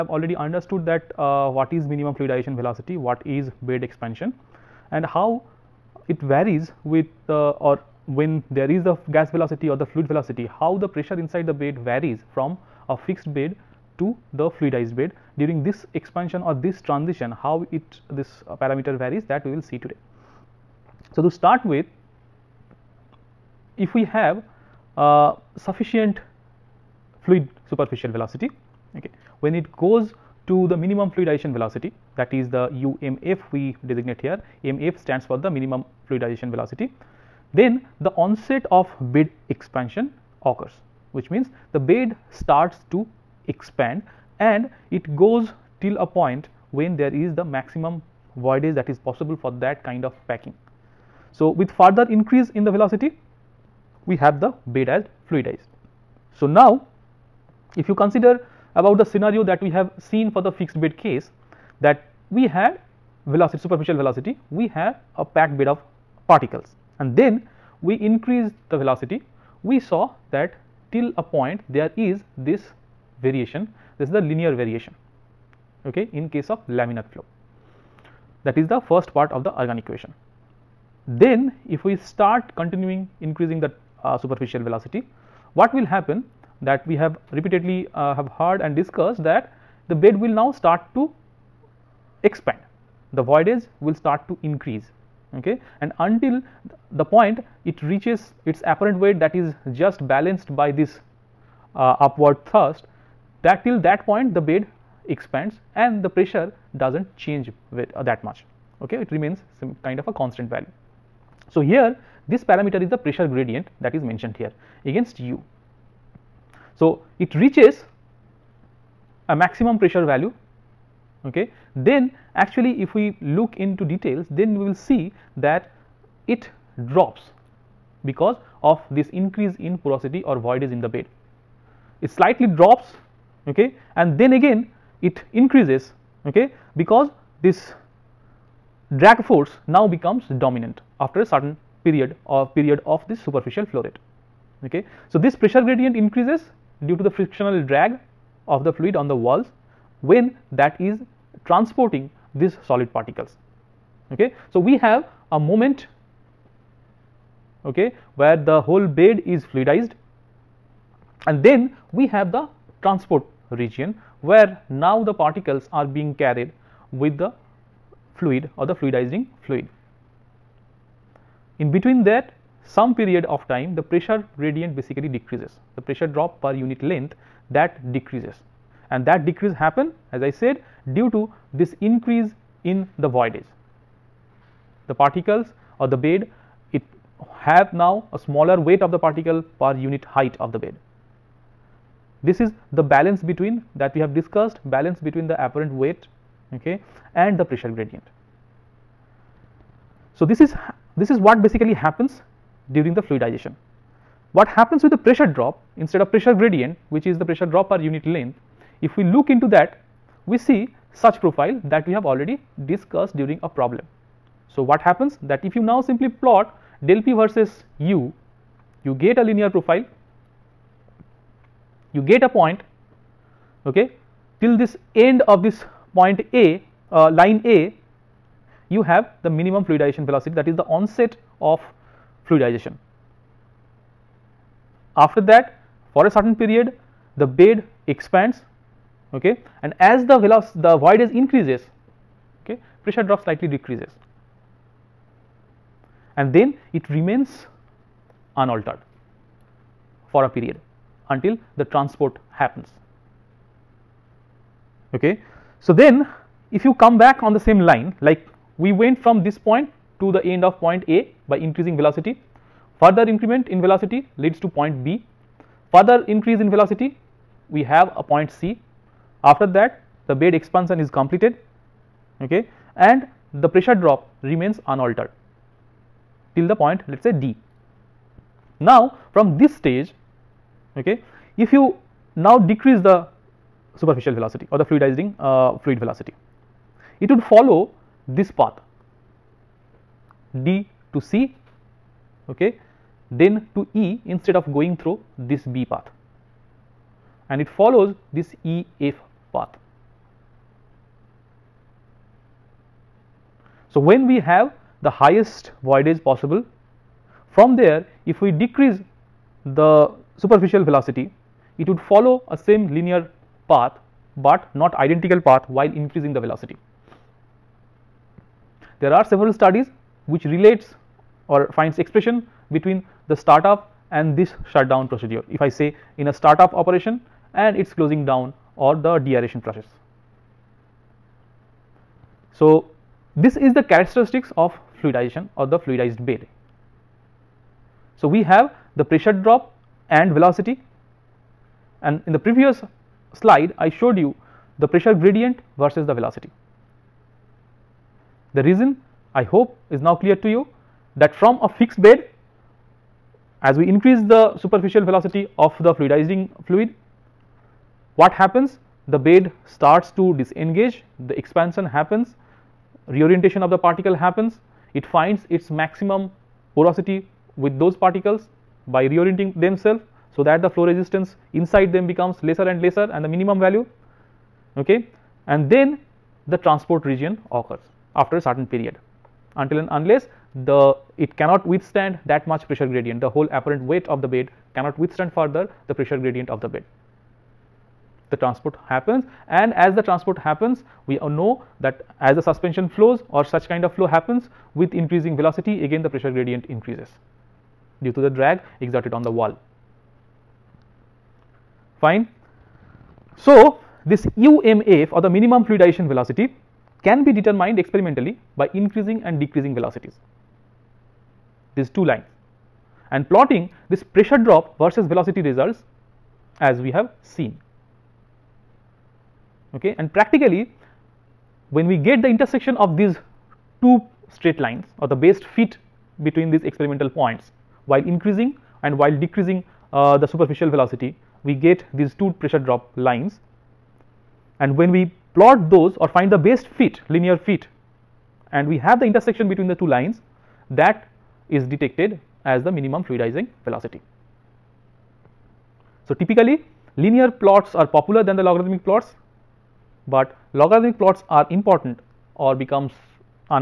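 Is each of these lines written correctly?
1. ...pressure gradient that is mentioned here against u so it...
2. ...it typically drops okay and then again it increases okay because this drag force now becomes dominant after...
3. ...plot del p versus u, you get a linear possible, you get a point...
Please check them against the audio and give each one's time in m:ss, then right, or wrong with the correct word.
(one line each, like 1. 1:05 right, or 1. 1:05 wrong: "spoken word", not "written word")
1. 1:52 right
2. 2:12 wrong: "slightly", not "typically"
3. 3:36 wrong: "profile", not "possible".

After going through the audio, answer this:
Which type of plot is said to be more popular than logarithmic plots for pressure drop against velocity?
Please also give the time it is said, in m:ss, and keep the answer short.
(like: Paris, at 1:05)
Linear plots, at 7:26.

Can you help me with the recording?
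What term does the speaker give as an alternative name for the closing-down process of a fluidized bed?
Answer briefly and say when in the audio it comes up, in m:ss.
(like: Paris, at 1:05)
Deaeration, at 5:28.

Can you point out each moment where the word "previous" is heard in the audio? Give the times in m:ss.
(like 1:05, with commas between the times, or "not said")
5:42.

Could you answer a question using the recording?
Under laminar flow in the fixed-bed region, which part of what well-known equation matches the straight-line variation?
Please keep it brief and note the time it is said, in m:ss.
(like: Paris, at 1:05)
First part of the Ergun equation, at 1:18.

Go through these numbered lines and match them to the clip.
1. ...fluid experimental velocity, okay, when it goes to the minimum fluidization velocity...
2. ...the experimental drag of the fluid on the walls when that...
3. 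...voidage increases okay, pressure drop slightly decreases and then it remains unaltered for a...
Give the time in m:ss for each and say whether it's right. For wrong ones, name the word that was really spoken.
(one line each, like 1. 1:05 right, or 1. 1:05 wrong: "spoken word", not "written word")
1. 0:27 wrong: "superficial", not "experimental"
2. 2:27 wrong: "frictional", not "experimental"
3. 4:00 right.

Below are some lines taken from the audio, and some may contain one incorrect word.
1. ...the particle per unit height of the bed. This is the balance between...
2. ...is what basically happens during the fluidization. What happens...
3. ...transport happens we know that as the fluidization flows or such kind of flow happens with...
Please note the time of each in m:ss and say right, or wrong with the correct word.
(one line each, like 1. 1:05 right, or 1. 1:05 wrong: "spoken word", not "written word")
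1. 3:08 right
2. 3:21 right
3. 6:29 wrong: "suspension", not "fluidization".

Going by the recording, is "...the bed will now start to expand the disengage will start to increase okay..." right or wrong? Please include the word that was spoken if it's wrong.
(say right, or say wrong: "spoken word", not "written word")
wrong: "voidage", not "disengage".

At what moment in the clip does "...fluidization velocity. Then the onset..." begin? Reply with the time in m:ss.
0:36.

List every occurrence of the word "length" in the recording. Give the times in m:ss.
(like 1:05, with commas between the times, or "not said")
2:56, 3:28.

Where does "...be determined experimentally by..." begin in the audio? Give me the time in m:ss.
6:47.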